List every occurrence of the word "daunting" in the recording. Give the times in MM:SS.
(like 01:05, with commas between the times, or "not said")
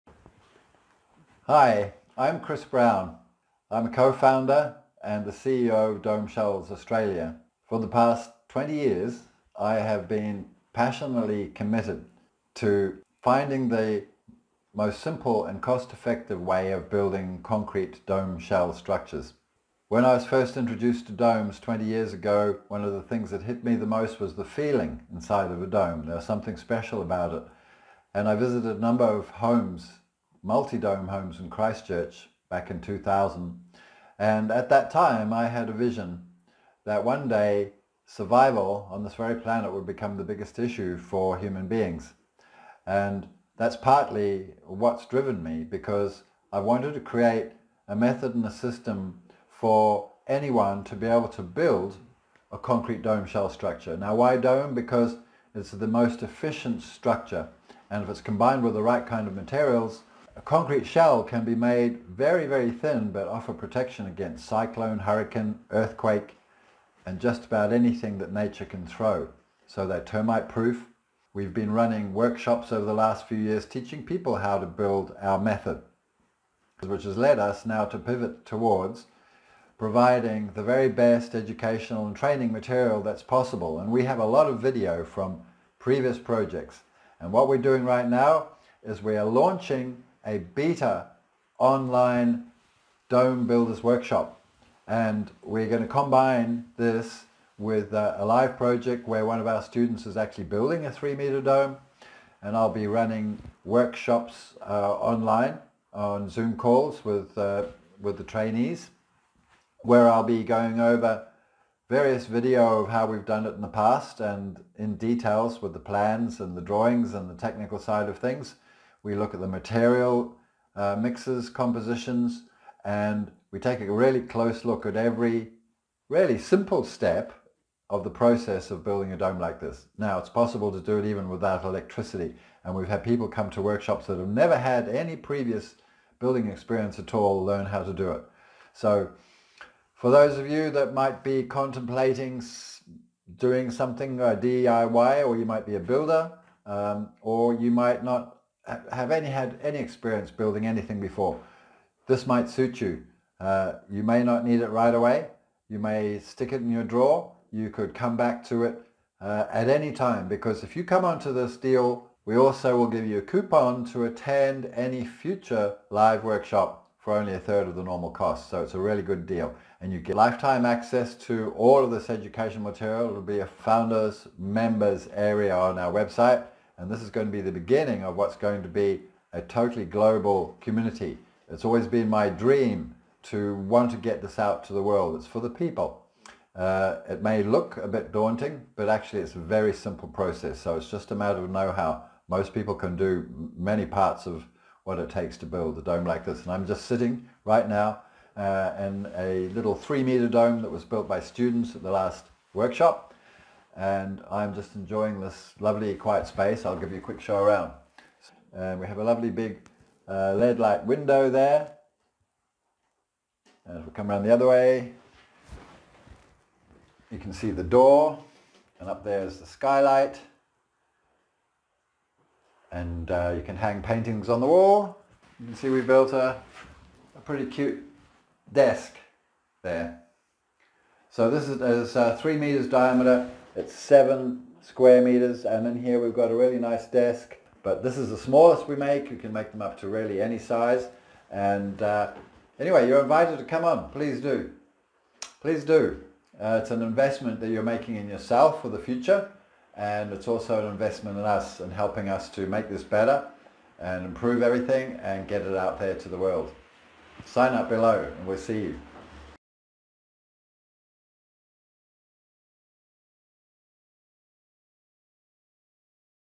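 03:08.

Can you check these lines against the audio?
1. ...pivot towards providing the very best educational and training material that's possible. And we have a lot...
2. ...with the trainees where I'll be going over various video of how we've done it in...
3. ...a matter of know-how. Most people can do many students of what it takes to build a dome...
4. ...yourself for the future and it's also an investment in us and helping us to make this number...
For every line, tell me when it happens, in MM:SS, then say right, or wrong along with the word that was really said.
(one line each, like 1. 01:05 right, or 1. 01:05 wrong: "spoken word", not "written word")
1. 01:17 right
2. 01:47 right
3. 03:11 wrong: "parts", not "students"
4. 04:08 wrong: "better", not "number".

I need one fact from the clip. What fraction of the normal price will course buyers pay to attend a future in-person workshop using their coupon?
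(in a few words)
a third.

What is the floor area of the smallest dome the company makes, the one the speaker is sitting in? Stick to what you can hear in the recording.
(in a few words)
7 square meters.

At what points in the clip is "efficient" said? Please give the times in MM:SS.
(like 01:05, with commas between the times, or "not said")
00:56.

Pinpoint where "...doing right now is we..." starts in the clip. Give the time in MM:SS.
01:27.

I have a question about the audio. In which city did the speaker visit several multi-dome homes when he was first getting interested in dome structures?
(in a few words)
Christchurch.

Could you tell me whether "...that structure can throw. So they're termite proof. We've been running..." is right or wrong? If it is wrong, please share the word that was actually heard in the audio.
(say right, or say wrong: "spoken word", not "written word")
wrong: "nature", not "structure".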